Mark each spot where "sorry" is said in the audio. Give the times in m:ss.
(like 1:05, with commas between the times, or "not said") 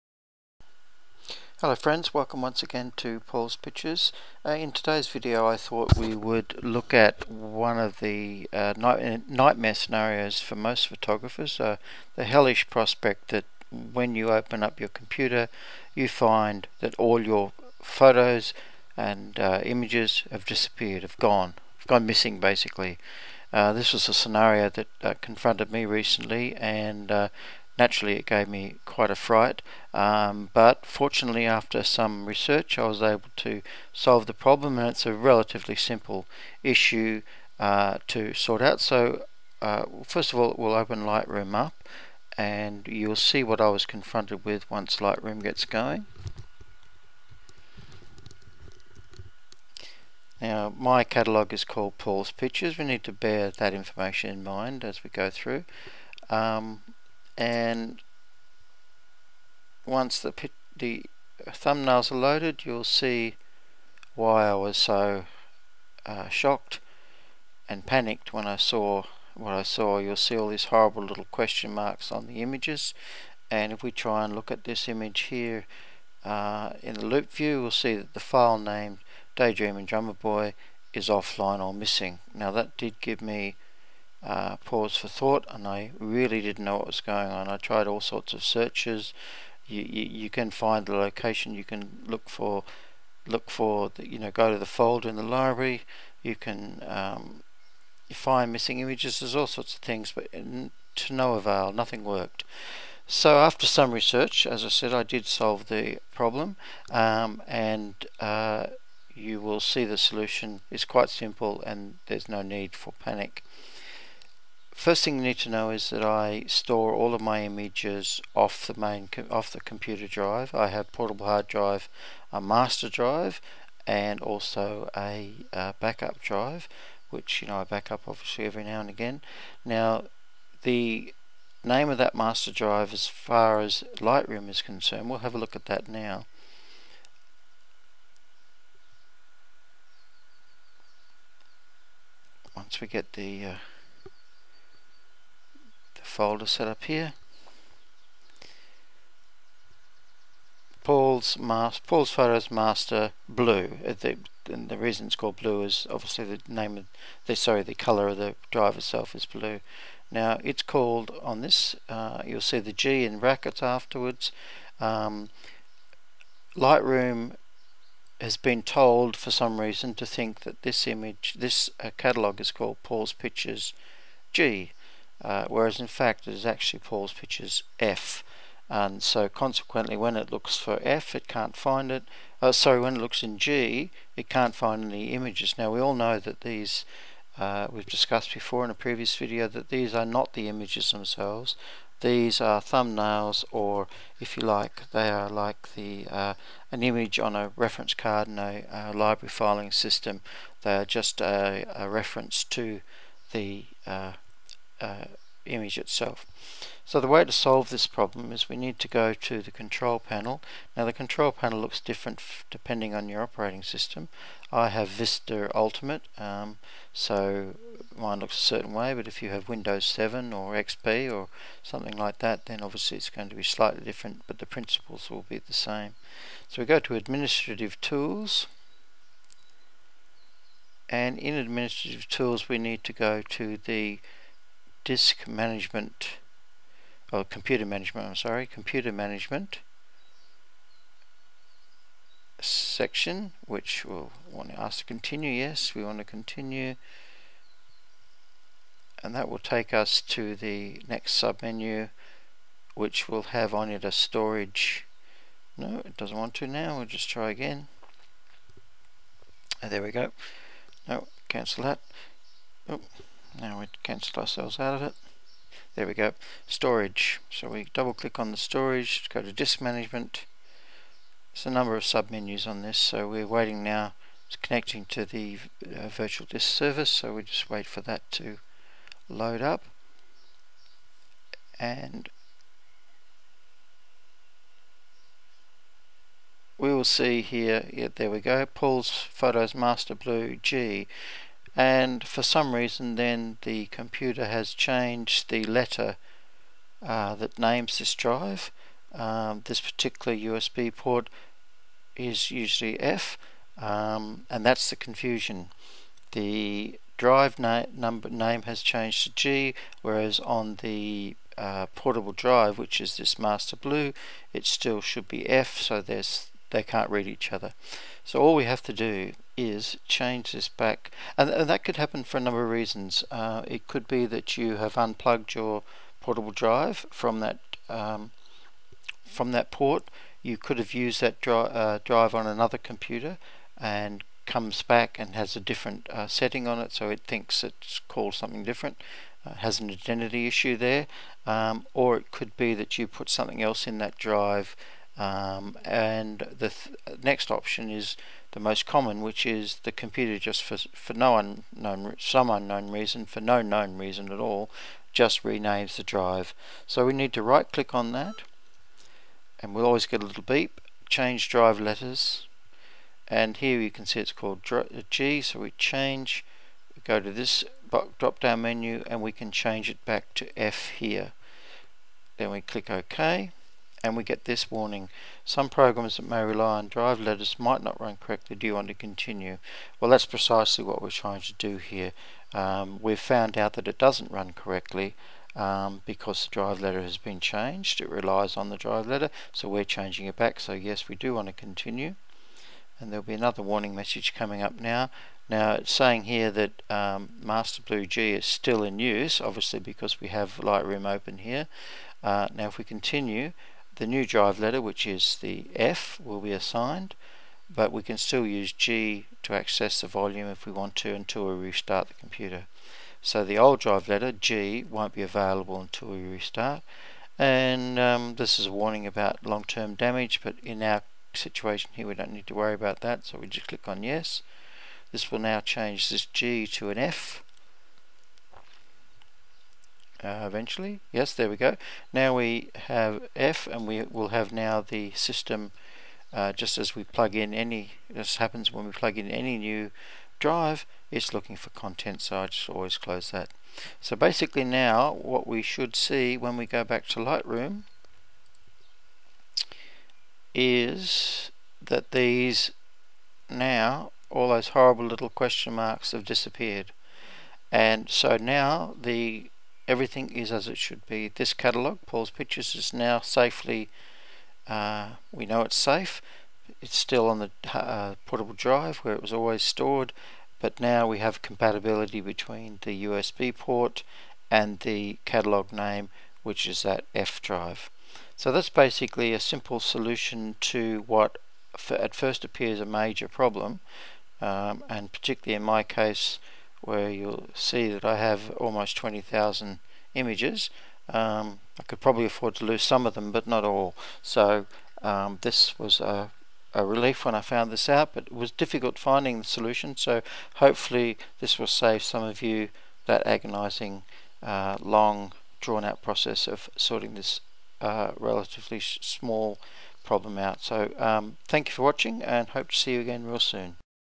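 2:37, 3:02, 3:58.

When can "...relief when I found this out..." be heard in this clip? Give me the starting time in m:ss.
8:16.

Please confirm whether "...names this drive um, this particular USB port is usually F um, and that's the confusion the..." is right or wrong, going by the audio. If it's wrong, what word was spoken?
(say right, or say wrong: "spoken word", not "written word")
right.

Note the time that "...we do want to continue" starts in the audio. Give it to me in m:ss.
6:30.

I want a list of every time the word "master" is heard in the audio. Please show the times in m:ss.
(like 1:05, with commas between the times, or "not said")
2:02, 2:12, 2:32, 4:49, 5:13, 6:37.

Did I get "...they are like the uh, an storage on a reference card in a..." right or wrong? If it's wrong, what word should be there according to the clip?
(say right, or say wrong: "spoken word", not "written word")
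wrong: "image", not "storage".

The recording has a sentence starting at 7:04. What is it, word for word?
This will now change this G to an F uh, eventually.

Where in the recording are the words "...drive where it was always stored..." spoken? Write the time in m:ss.
7:48.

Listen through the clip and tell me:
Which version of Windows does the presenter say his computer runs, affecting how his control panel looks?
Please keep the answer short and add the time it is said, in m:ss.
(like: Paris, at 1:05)
Vista Ultimate, at 3:34.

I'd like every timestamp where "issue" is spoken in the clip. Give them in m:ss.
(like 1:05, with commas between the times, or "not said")
0:36, 5:40.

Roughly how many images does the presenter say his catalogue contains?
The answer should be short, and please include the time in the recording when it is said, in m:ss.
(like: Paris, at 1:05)
20,000, at 8:08.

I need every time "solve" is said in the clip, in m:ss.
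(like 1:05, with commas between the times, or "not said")
0:33, 1:45, 3:27.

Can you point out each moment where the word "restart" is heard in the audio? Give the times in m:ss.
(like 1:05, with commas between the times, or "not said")
6:51, 6:56.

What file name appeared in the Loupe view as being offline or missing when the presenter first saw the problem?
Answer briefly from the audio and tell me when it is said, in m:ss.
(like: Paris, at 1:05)
Daydream and Drummer Boy, at 1:19.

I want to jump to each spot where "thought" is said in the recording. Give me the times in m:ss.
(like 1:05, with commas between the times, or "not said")
0:05, 1:25.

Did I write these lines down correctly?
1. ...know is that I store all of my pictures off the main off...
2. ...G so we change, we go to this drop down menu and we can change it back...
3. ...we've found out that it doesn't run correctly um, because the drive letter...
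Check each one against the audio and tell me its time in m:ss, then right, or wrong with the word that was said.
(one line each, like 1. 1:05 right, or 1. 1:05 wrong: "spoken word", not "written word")
1. 1:55 wrong: "images", not "pictures"
2. 6:04 right
3. 6:22 right.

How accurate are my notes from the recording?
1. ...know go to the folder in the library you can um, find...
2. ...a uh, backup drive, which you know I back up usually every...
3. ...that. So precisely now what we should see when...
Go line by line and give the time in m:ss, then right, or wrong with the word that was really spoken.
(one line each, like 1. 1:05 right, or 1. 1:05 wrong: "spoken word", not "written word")
1. 1:34 right
2. 2:04 wrong: "obviously", not "usually"
3. 7:23 wrong: "basically", not "precisely".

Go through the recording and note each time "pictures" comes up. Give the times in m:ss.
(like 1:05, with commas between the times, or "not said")
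0:03, 0:52, 2:53, 2:57, 7:42.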